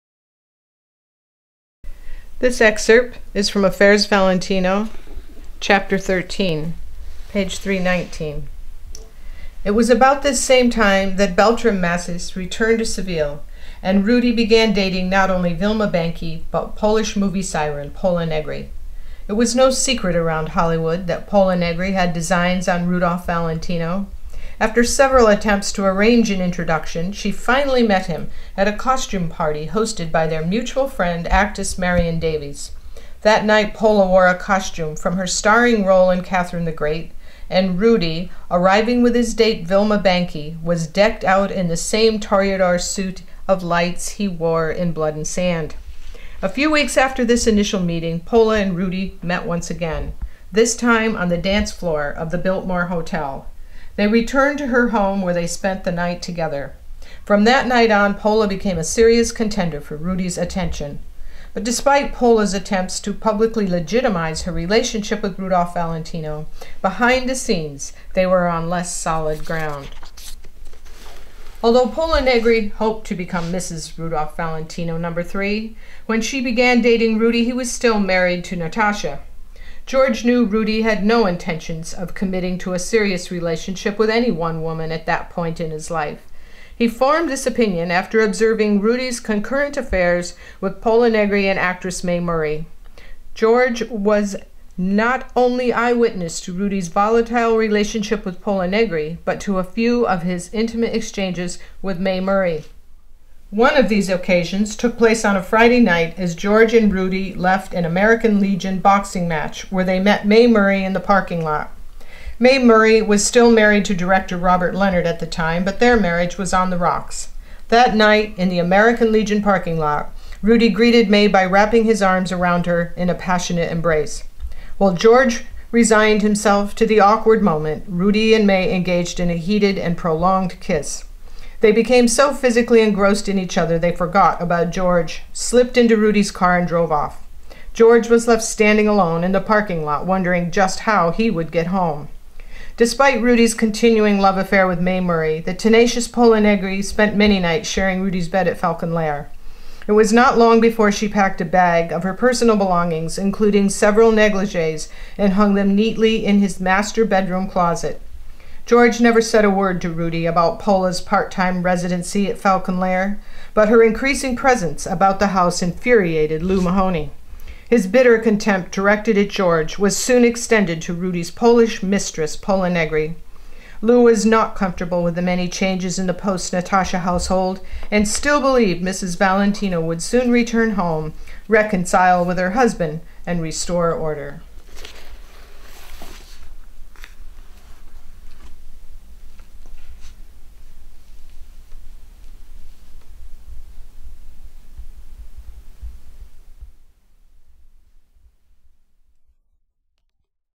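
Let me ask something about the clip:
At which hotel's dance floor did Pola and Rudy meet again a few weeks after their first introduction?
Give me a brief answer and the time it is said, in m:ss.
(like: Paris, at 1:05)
Biltmore Hotel, at 0:52.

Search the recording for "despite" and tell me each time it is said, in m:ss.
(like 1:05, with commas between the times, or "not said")
1:01, 2:22.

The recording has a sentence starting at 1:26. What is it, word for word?
He formed this opinion after observing Rudy's concurrent affairs with Pola Negri and actress Mae Murray.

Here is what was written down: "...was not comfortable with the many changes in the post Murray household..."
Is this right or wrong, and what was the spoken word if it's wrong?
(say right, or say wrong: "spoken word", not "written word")
wrong: "Natasha", not "Murray".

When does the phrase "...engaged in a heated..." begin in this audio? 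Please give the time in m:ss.
2:08.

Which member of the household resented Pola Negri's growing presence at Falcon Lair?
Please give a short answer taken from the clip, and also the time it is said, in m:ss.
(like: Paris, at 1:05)
Lou Mahoney, at 2:46.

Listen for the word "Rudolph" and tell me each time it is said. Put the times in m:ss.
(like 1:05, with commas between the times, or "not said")
0:22, 1:05, 1:13.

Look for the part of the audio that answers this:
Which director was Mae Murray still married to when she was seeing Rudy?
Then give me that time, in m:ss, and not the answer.
1:54.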